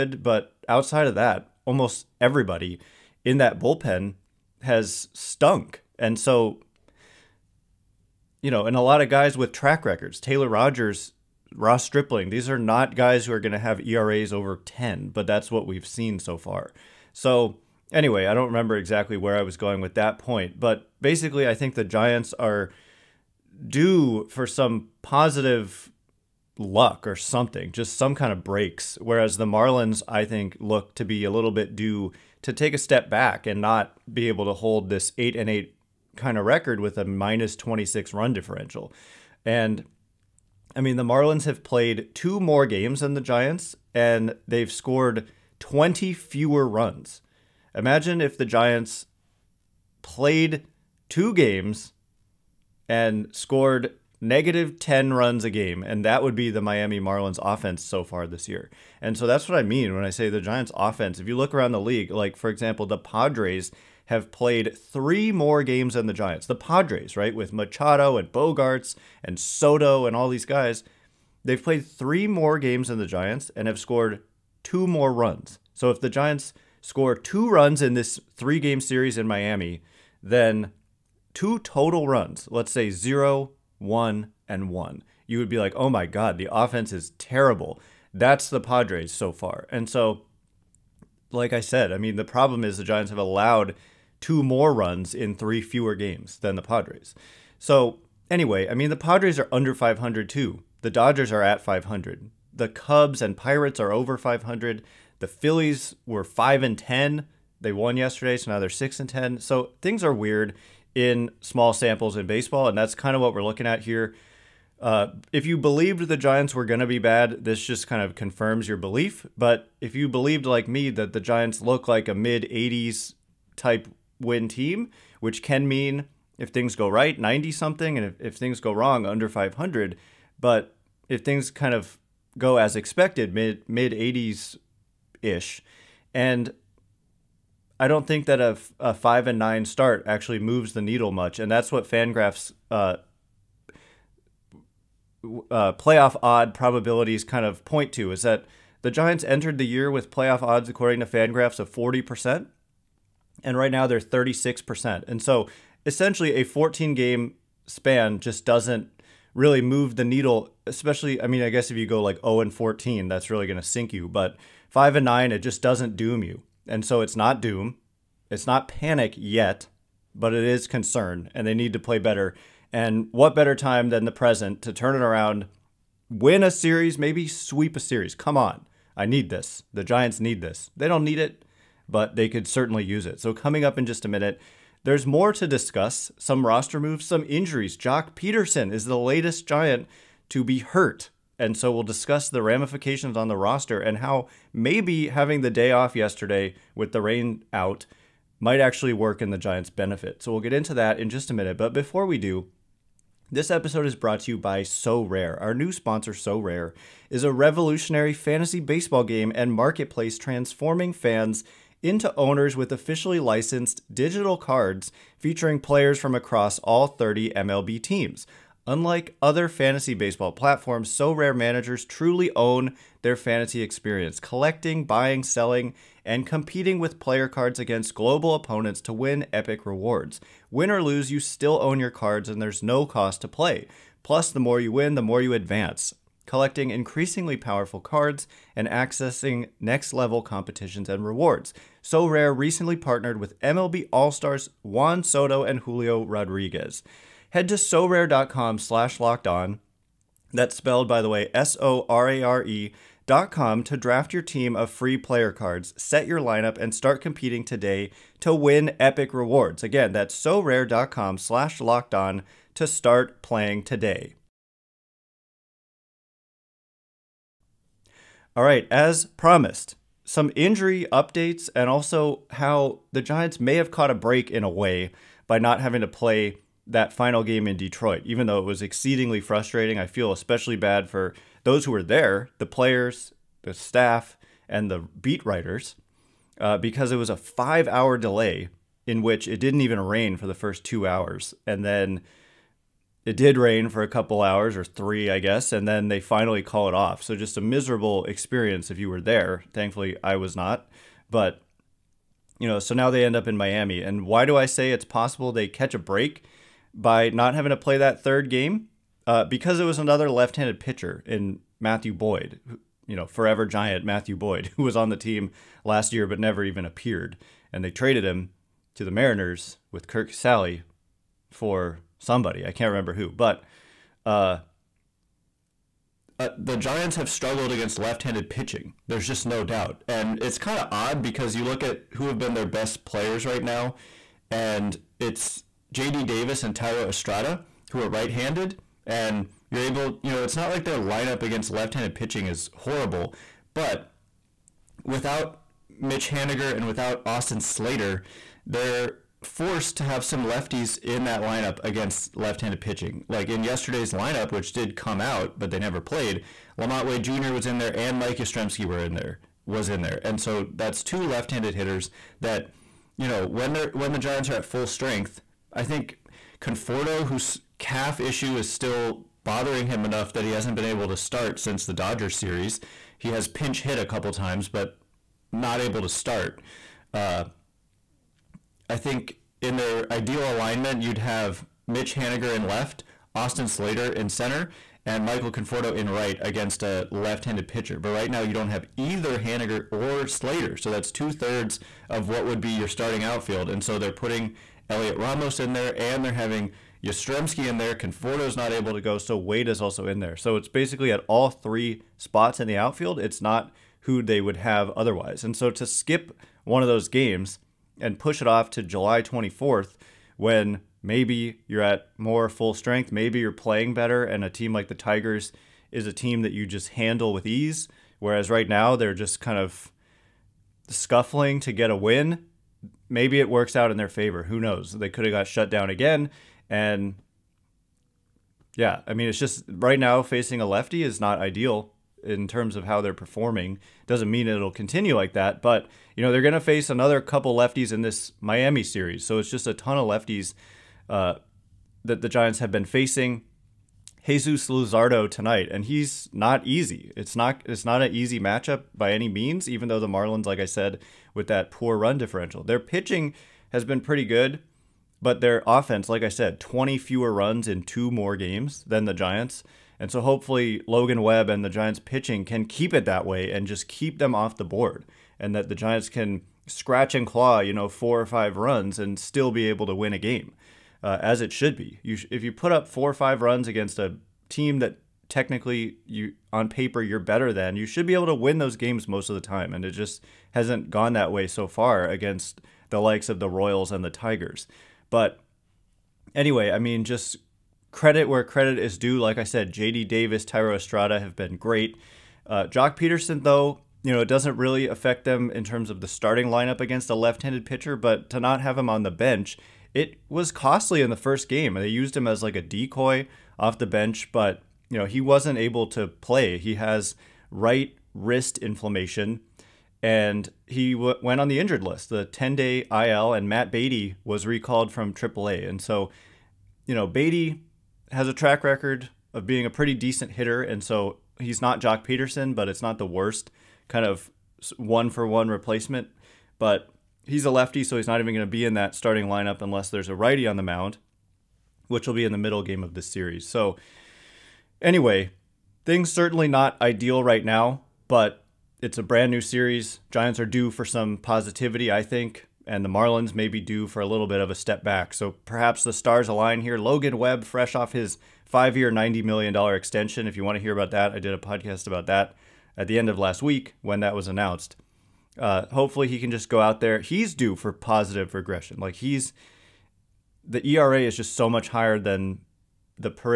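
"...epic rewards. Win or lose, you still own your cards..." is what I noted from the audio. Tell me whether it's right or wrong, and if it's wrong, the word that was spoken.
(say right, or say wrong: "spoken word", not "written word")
right.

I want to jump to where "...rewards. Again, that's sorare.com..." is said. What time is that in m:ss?
4:19.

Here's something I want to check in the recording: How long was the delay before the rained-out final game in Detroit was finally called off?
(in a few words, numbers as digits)
5 hours.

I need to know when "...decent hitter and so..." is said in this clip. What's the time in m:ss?
8:39.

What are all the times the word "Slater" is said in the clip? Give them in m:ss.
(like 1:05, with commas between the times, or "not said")
5:47, 6:23, 6:30.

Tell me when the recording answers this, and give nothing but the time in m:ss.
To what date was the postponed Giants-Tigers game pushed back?
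6:48.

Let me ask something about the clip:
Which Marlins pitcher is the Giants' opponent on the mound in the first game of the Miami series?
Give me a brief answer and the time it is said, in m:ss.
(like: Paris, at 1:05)
Jesus Luzardo, at 7:24.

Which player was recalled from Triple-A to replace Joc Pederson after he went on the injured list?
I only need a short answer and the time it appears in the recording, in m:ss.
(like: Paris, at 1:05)
Matt Beaty, at 8:33.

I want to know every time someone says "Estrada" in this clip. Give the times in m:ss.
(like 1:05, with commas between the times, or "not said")
5:36, 8:10.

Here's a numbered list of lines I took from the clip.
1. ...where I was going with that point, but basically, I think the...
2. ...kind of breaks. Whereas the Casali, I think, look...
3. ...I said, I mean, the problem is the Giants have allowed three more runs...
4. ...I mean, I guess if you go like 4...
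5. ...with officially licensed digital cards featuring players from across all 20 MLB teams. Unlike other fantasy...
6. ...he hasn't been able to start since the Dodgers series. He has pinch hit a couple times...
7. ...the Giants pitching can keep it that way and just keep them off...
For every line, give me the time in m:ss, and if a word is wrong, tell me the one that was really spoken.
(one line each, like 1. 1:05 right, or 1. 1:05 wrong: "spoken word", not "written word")
1. 0:19 right
2. 0:28 wrong: "Marlins", not "Casali"
3. 1:31 wrong: "two", not "three"
4. 2:41 wrong: "0", not "4"
5. 3:32 wrong: "30", not "20"
6. 6:10 right
7. 7:41 right.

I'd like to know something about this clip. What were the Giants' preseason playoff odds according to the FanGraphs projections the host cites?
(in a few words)
40%.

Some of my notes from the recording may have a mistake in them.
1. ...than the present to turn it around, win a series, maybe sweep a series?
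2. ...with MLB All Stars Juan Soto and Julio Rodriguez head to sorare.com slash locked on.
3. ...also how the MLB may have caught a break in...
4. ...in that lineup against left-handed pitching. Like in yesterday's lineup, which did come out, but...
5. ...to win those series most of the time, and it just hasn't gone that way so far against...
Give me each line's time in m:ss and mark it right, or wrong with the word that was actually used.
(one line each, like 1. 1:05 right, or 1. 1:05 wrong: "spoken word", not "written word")
1. 2:53 right
2. 4:03 right
3. 4:31 wrong: "Giants", not "MLB"
4. 5:50 right
5. 7:58 wrong: "games", not "series".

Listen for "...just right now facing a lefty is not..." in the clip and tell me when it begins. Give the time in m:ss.
7:09.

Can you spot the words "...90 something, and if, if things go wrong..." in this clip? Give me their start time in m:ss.
2:07.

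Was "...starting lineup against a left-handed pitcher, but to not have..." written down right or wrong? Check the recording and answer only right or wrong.
right.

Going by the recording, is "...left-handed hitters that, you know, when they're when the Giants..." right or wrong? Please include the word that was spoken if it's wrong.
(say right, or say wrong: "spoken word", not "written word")
right.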